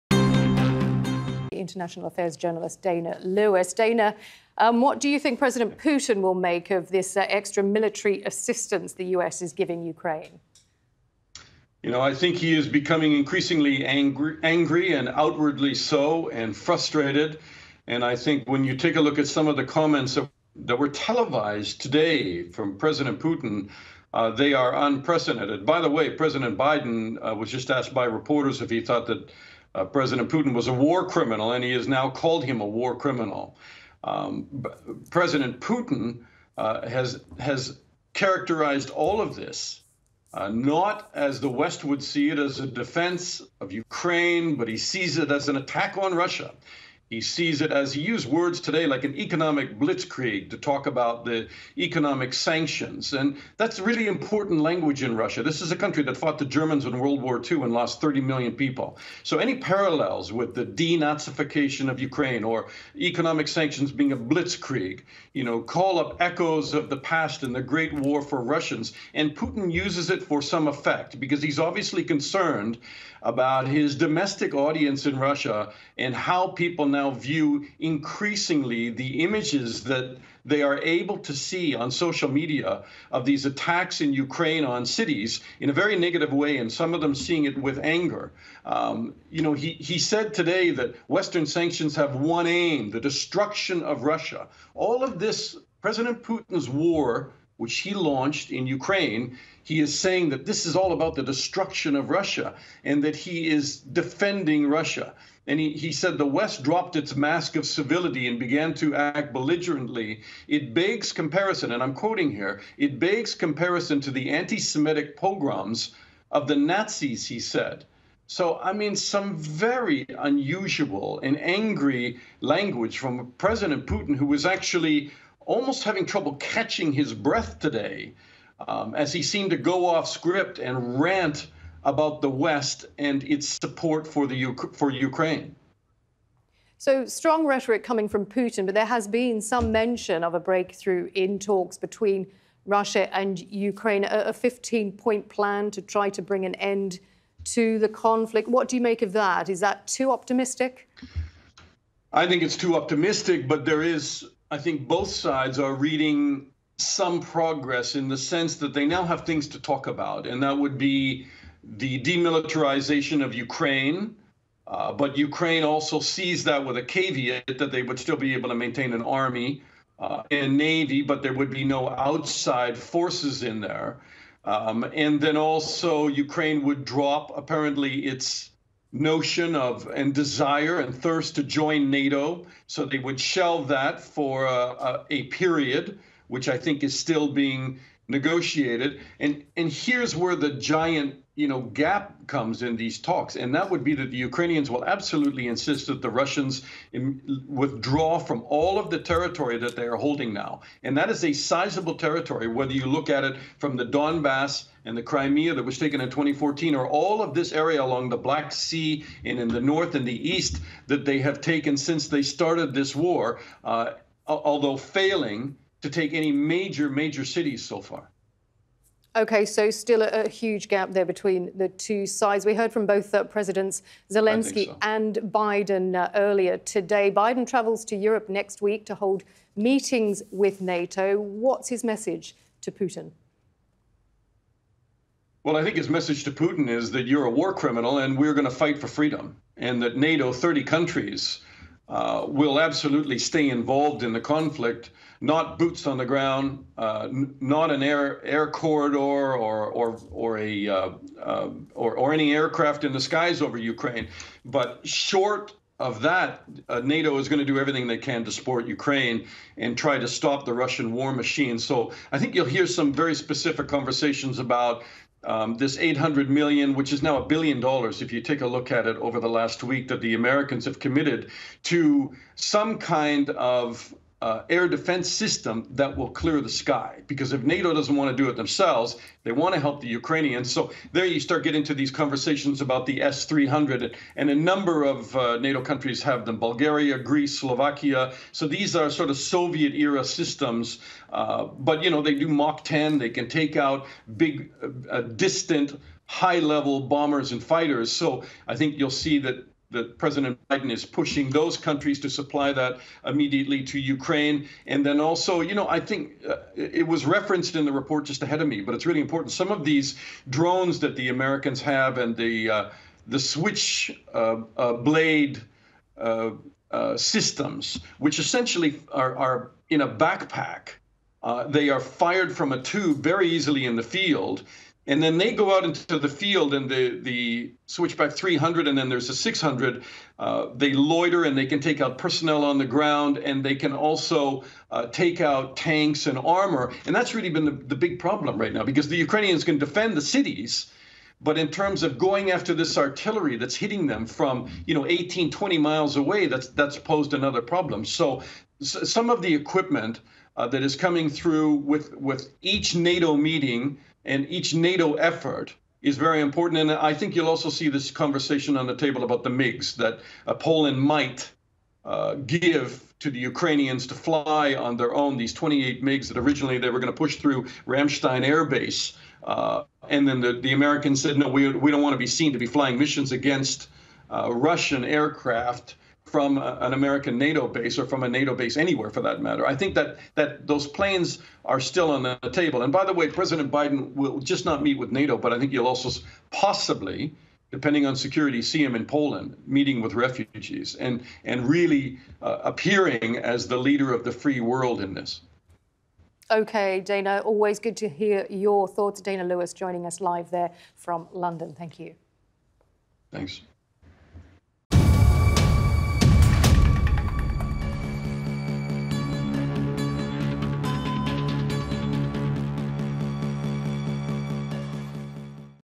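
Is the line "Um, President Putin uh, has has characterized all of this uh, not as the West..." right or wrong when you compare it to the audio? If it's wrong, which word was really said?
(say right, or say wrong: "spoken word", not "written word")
right.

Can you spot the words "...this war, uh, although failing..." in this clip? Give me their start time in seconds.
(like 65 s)
212 s.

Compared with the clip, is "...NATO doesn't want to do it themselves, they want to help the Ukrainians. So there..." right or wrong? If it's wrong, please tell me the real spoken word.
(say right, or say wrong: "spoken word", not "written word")
right.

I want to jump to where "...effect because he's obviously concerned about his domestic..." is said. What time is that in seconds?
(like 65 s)
70 s.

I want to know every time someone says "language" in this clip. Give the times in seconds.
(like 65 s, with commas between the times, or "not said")
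54 s, 122 s.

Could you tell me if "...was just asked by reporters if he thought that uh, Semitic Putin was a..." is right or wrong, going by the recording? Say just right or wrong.
wrong.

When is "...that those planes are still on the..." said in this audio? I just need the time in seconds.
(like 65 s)
380 s.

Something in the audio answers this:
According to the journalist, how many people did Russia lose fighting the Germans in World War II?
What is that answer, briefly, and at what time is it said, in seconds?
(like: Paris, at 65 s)
30 million, at 57 s.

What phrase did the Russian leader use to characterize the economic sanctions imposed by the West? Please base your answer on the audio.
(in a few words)
economic blitzkrieg.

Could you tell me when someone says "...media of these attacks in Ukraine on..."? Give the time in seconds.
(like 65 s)
82 s.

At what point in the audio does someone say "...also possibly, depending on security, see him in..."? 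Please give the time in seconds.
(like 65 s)
385 s.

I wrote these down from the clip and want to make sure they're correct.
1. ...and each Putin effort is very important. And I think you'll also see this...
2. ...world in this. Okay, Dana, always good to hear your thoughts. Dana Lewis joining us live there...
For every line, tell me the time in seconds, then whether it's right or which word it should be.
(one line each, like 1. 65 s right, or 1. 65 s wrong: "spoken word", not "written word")
1. 354 s wrong: "NATO", not "Putin"
2. 394 s right.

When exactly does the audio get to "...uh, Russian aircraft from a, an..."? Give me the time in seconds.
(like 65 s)
374 s.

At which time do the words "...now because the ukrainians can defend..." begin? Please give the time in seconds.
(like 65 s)
338 s.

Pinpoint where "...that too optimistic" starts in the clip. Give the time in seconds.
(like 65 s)
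149 s.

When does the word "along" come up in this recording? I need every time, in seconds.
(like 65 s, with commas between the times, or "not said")
207 s.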